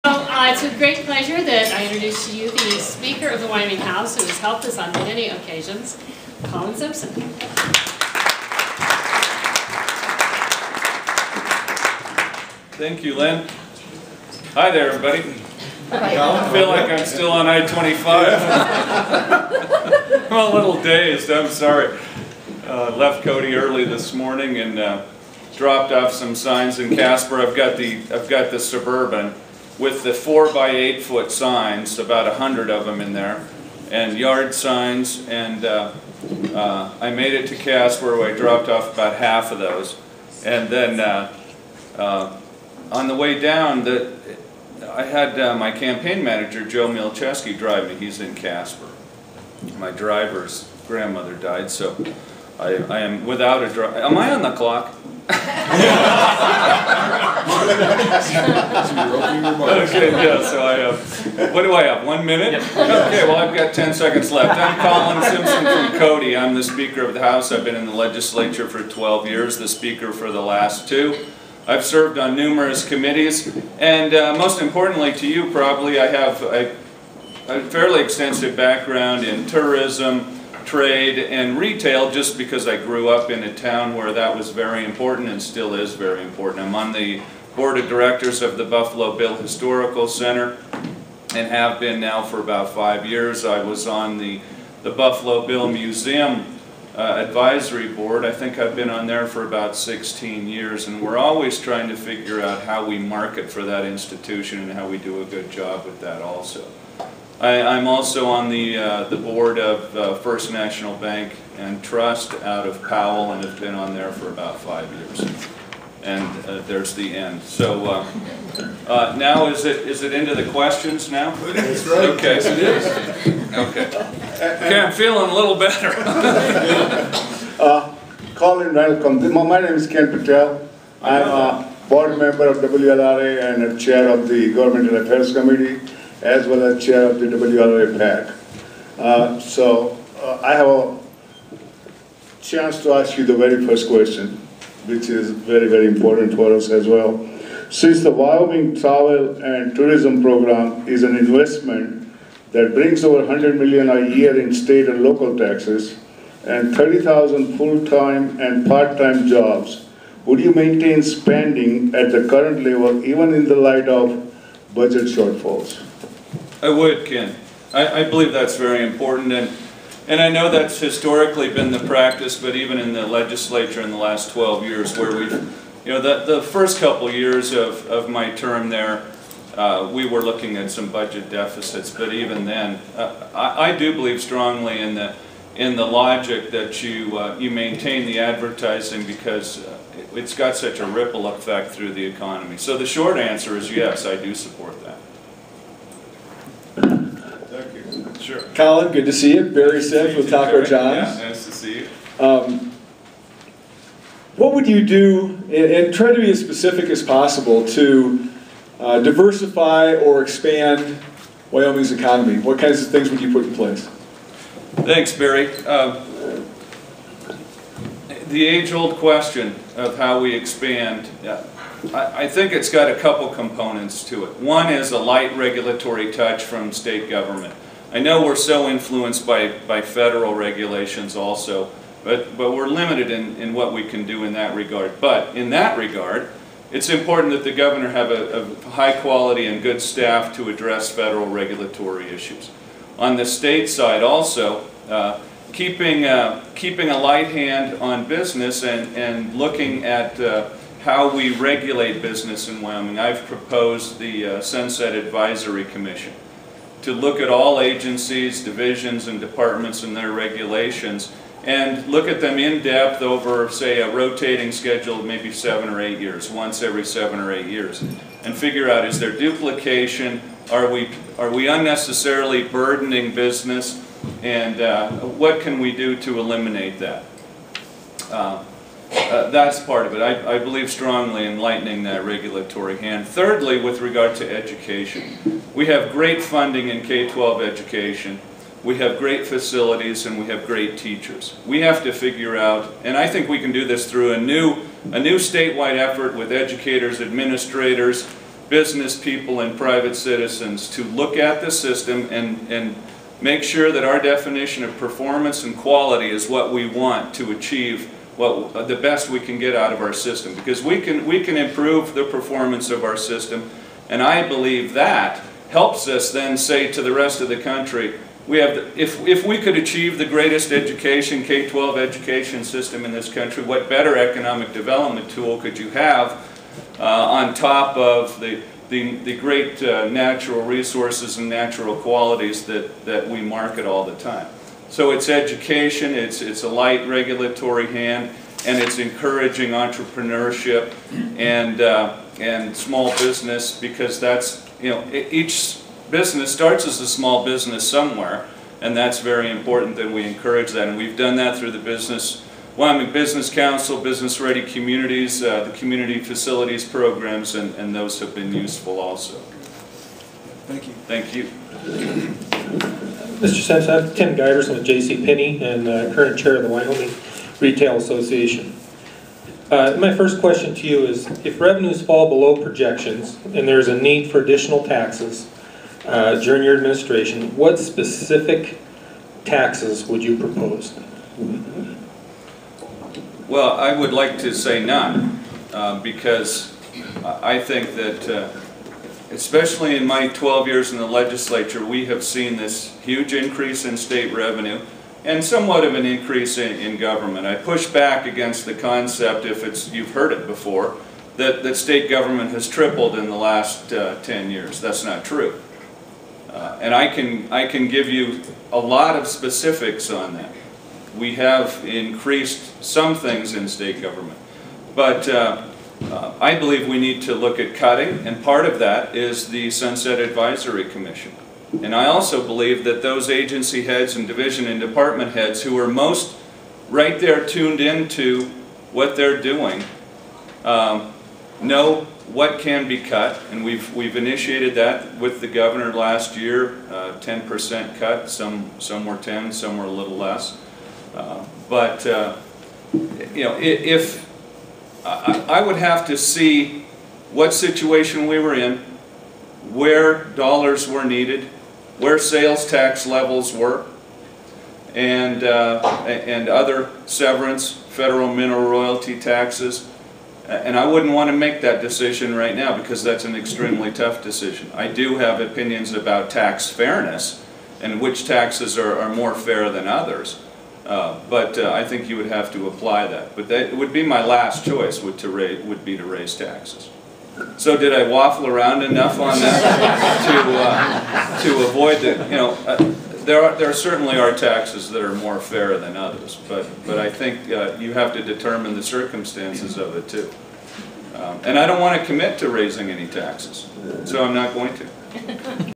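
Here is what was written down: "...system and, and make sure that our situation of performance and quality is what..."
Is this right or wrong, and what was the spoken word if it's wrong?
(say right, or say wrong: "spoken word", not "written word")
wrong: "definition", not "situation".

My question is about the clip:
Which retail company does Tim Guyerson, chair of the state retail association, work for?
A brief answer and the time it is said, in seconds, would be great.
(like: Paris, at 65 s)
J.C. Penney, at 364 s.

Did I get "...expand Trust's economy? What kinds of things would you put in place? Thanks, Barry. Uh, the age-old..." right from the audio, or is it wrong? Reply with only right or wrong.
wrong.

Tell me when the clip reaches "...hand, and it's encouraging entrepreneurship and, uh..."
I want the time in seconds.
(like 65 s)
337 s.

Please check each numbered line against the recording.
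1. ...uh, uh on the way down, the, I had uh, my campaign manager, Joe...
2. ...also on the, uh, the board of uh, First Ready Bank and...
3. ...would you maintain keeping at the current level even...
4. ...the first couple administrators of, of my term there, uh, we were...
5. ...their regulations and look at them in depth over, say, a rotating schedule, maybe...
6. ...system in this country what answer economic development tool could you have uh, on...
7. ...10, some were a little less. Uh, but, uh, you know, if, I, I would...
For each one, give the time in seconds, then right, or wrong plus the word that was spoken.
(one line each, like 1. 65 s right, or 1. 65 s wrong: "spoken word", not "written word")
1. 40 s right
2. 107 s wrong: "National", not "Ready"
3. 160 s wrong: "spending", not "keeping"
4. 176 s wrong: "years", not "administrators"
5. 259 s right
6. 322 s wrong: "better", not "answer"
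7. 438 s right.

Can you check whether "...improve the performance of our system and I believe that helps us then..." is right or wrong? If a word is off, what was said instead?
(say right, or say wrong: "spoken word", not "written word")
right.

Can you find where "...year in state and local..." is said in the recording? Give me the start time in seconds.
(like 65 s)
154 s.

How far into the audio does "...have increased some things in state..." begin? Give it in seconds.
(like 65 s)
411 s.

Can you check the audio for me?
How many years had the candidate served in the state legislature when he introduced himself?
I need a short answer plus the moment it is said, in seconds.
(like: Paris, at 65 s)
12, at 68 s.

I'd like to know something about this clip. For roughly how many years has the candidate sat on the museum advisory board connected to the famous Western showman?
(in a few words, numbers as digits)
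16.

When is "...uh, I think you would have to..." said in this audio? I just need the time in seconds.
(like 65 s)
471 s.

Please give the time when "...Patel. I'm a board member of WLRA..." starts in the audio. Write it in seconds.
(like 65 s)
130 s.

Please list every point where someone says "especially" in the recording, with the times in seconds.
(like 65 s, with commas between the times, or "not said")
389 s.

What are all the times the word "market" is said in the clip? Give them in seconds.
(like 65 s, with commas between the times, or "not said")
102 s, 333 s.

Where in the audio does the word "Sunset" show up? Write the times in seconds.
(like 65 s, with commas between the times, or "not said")
254 s, 419 s.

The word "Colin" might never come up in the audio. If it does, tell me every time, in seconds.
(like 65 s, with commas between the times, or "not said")
6 s, 64 s, 128 s, 198 s.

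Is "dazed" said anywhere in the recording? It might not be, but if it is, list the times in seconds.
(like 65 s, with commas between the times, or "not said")
20 s.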